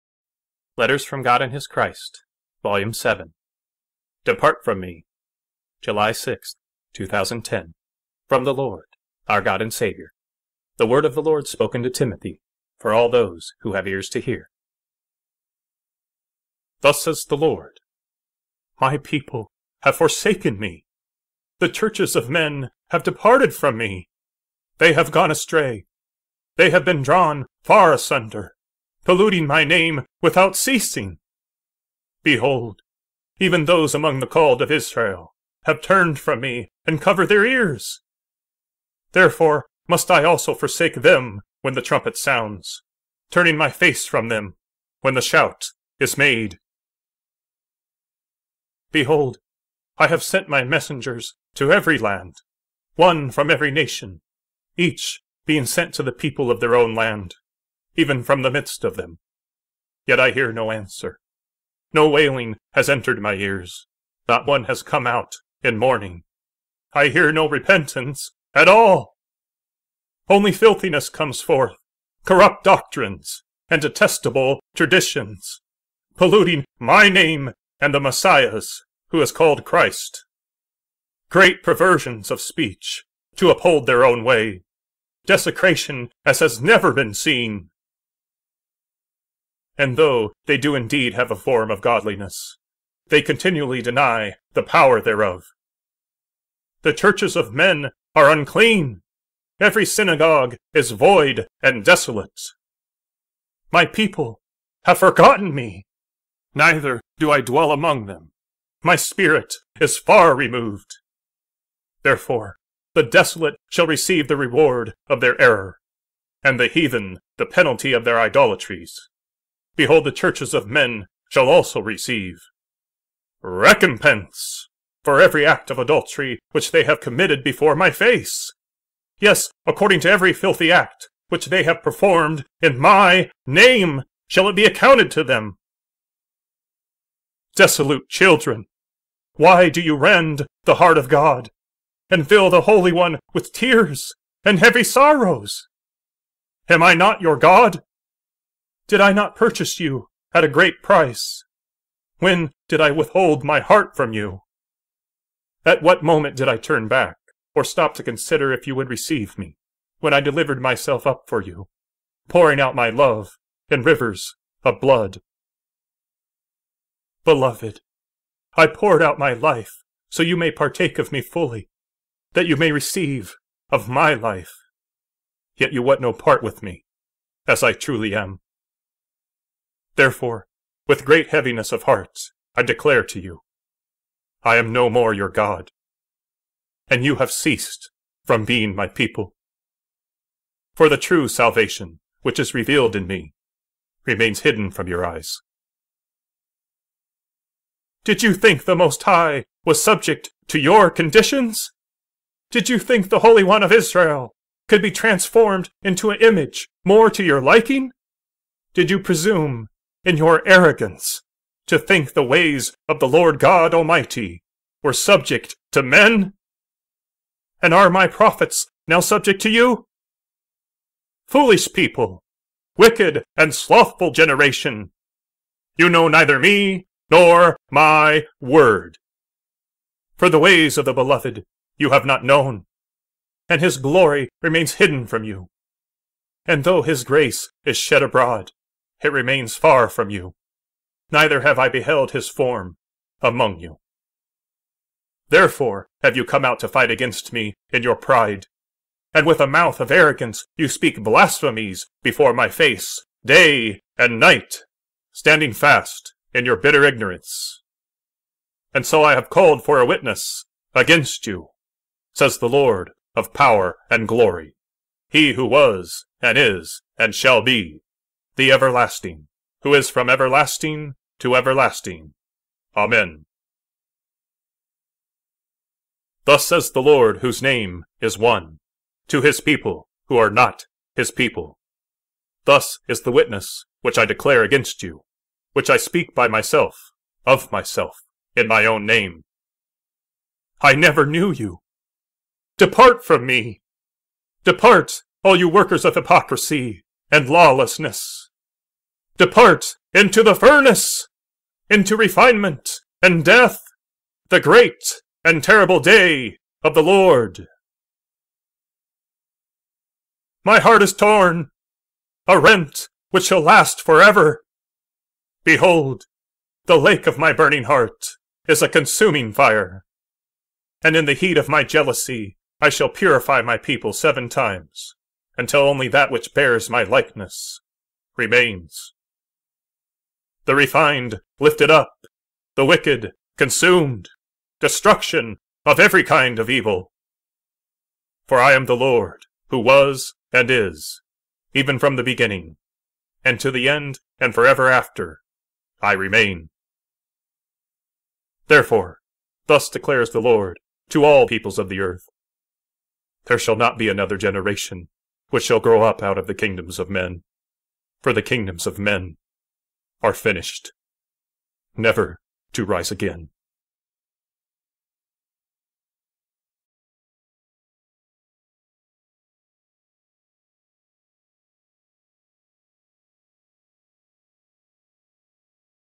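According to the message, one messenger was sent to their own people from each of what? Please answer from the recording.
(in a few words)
nation.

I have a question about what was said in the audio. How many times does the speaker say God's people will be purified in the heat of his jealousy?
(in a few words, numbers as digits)
7.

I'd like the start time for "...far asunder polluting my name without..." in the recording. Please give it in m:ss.
0:27.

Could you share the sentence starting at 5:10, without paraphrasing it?
My heart is torn, a rent which shall last forever.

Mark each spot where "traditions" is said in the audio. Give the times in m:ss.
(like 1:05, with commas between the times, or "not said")
1:14.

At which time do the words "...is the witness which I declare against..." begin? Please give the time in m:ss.
4:42.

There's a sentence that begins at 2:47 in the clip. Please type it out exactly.
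Beloved, I poured out my life so you may partake of me fully, that you may receive of my life.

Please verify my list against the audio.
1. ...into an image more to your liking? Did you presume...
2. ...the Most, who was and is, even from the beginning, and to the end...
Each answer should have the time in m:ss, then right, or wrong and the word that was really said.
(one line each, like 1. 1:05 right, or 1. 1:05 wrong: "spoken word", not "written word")
1. 3:25 right
2. 5:38 wrong: "Lord", not "Most".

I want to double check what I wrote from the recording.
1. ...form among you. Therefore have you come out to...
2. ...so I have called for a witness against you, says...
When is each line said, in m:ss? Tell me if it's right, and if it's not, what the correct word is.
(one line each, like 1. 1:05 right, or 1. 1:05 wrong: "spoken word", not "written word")
1. 4:02 right
2. 4:18 right.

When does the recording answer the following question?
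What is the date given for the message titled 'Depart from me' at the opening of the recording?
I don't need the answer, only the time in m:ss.
0:05.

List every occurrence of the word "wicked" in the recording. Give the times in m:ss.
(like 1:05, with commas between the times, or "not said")
3:42, 5:32.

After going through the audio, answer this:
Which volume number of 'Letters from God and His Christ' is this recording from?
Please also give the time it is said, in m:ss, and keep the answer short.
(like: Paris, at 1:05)
7, at 0:02.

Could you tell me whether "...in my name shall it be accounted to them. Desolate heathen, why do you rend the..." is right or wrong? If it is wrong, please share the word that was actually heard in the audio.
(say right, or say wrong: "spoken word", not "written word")
wrong: "children", not "heathen".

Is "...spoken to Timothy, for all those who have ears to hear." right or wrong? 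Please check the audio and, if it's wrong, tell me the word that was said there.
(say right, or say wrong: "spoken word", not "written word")
right.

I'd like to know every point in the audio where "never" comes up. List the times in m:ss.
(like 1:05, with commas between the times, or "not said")
1:26, 4:50, 6:01.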